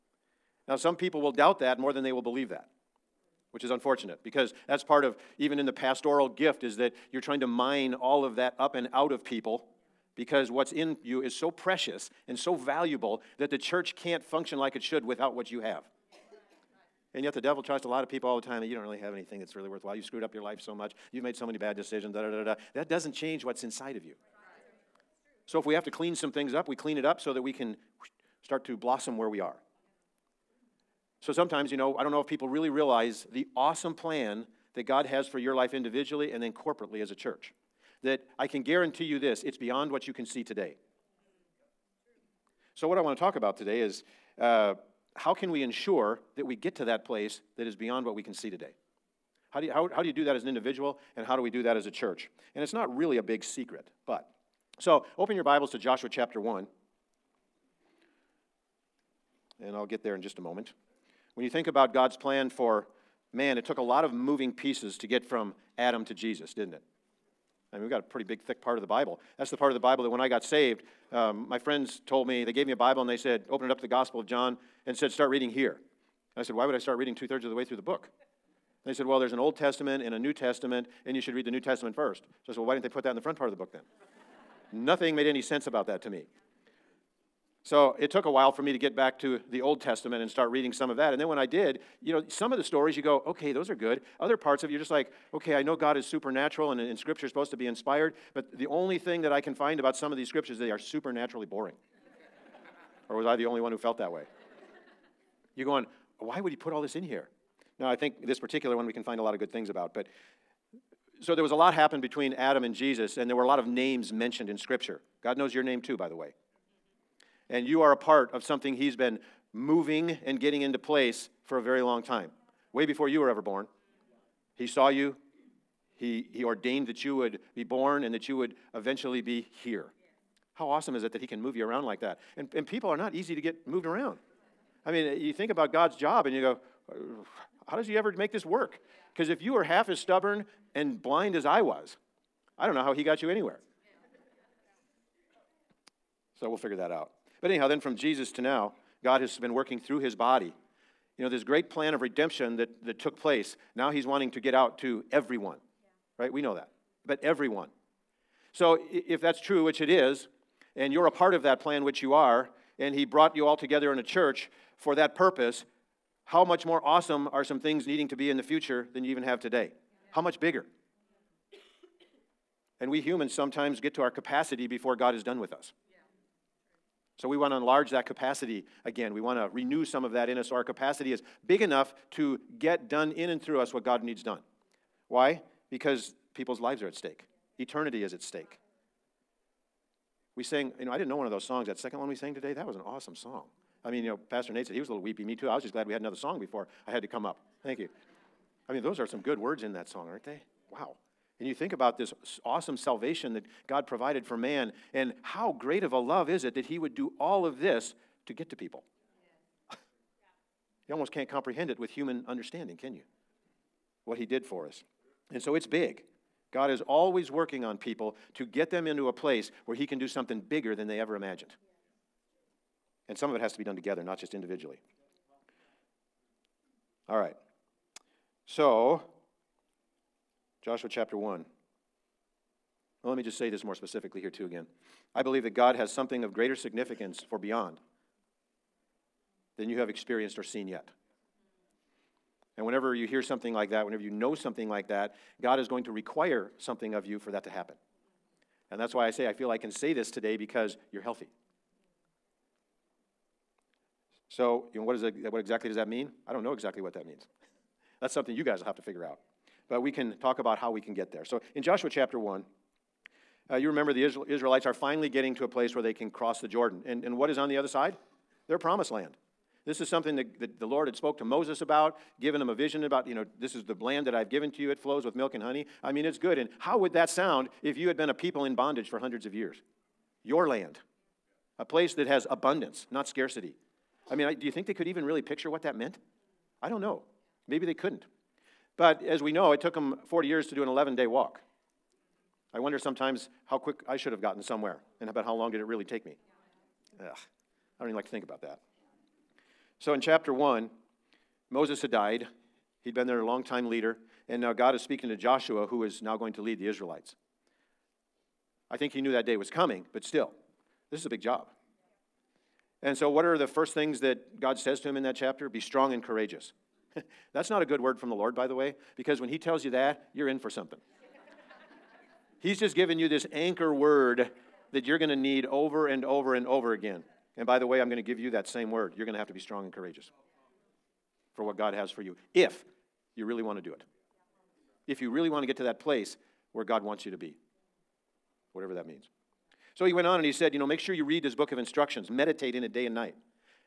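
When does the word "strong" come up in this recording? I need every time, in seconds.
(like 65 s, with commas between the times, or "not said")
315 s, 329 s.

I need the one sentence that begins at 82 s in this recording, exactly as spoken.
So I said, well, why didn't they put that in the front part of the book then?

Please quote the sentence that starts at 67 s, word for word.
I mean, we've got a pretty big, thick part of the Bible.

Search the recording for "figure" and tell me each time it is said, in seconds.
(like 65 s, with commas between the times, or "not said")
146 s, 258 s.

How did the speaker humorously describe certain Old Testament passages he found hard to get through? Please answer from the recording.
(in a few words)
Supernaturally boring.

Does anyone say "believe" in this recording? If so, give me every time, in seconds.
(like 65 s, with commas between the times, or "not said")
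2 s, 235 s.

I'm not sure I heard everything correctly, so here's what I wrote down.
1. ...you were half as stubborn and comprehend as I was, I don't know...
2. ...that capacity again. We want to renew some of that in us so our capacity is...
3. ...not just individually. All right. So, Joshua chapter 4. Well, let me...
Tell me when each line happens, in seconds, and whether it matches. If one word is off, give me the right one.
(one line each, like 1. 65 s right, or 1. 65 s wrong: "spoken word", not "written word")
1. 139 s wrong: "blind", not "comprehend"
2. 177 s right
3. 224 s wrong: "1", not "4".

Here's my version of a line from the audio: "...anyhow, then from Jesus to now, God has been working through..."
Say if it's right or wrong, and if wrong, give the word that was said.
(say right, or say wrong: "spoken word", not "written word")
right.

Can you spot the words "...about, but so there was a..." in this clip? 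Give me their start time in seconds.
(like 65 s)
109 s.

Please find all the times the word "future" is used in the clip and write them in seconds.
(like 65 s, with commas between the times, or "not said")
168 s.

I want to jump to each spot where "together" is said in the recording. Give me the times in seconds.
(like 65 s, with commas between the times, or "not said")
163 s, 223 s.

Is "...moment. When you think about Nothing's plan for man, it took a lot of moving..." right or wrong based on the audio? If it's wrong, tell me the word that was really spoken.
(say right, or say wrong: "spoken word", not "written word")
wrong: "God", not "Nothing".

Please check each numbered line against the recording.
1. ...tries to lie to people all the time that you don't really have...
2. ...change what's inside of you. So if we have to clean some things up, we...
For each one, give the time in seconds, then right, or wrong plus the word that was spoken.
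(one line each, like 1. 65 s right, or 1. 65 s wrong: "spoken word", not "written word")
1. 17 s right
2. 23 s right.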